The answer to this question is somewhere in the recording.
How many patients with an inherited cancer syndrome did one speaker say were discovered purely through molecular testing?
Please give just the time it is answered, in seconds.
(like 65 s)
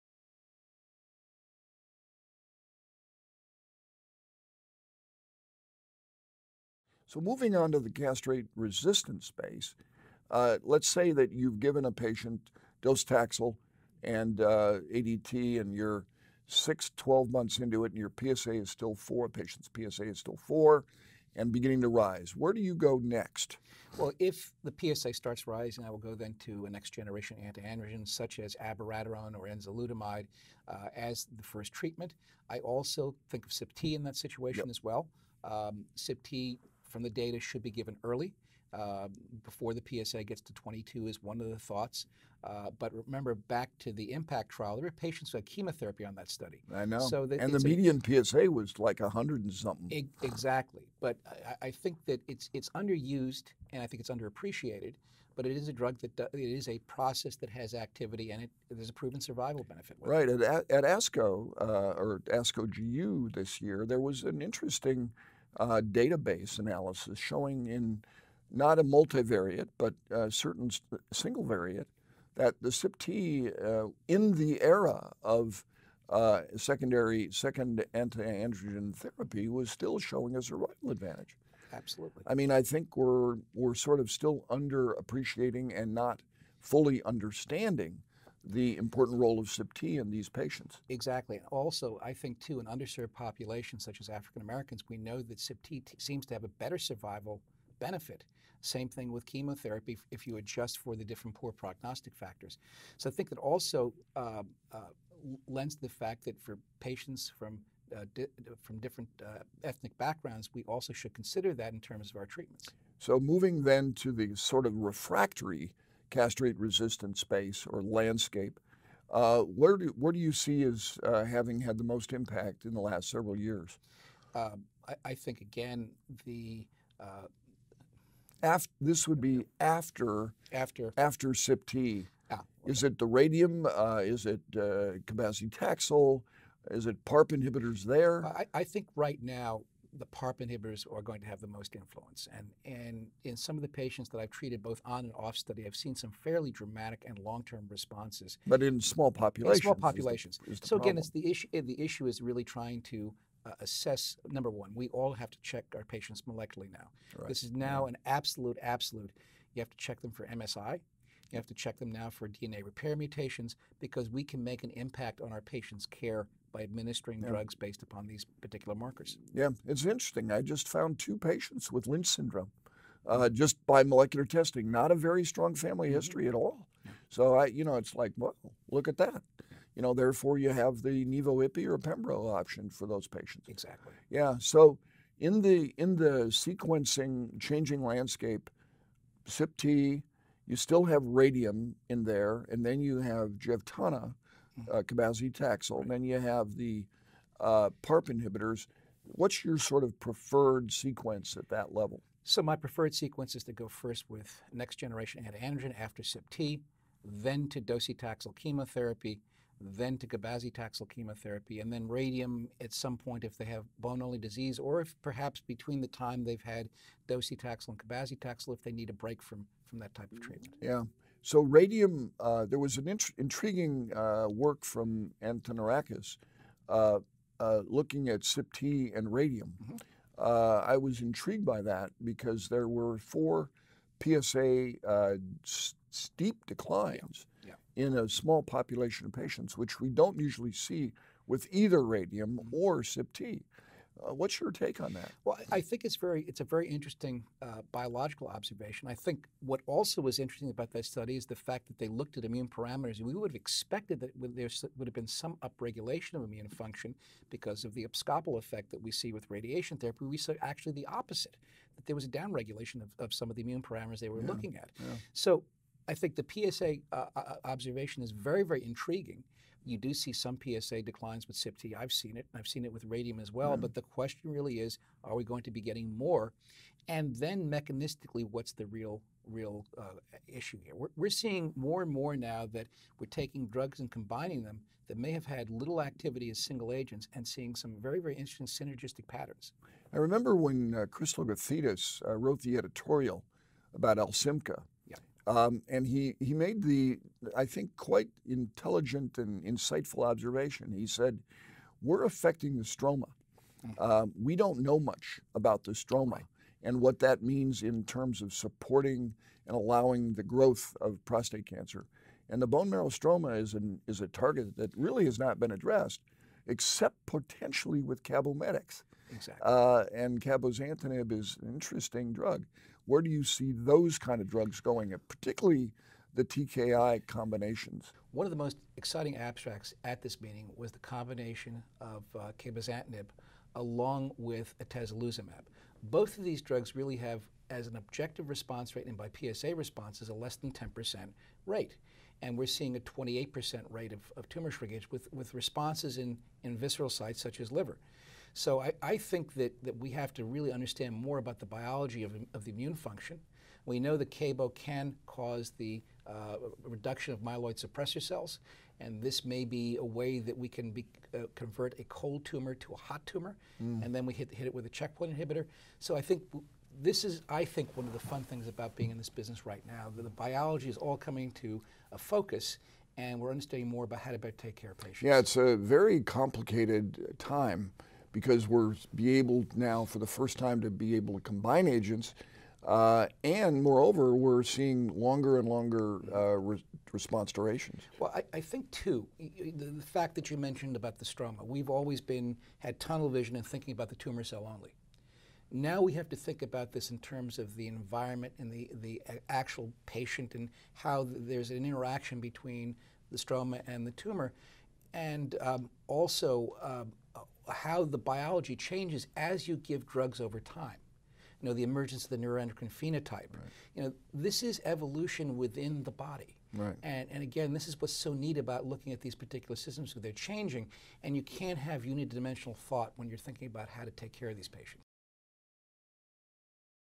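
170 s.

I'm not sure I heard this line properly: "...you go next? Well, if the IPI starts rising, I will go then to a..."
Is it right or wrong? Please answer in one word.
wrong.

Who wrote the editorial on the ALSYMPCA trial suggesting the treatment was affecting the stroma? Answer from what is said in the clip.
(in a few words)
Chris Logothetis.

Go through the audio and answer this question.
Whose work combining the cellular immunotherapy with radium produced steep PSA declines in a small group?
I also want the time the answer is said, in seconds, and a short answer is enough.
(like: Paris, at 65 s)
Antonarakis, at 225 s.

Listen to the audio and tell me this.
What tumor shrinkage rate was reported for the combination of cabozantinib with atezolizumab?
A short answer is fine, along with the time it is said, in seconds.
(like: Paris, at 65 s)
28%, at 342 s.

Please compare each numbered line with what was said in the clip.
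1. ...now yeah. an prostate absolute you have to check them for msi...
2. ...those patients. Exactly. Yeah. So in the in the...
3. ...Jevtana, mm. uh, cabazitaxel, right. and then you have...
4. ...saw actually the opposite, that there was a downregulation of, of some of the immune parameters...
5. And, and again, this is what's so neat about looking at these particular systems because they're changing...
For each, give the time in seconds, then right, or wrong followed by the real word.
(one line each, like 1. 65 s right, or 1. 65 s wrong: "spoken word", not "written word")
1. 157 s wrong: "absolute", not "prostate"
2. 182 s right
3. 193 s right
4. 260 s right
5. 416 s right.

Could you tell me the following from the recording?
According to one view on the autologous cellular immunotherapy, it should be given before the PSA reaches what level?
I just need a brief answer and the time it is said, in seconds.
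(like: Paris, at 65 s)
22, at 40 s.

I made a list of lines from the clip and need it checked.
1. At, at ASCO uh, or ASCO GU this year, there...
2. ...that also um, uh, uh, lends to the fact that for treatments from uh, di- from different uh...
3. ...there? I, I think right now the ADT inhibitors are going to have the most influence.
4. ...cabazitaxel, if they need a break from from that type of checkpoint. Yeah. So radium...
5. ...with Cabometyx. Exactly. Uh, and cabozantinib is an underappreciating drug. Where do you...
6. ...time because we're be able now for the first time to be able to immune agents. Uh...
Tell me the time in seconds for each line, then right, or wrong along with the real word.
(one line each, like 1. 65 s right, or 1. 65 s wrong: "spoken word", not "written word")
1. 60 s right
2. 103 s wrong: "patients", not "treatments"
3. 137 s wrong: "PARP", not "ADT"
4. 217 s wrong: "treatment", not "checkpoint"
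5. 317 s wrong: "interesting", not "underappreciating"
6. 377 s wrong: "combine", not "immune".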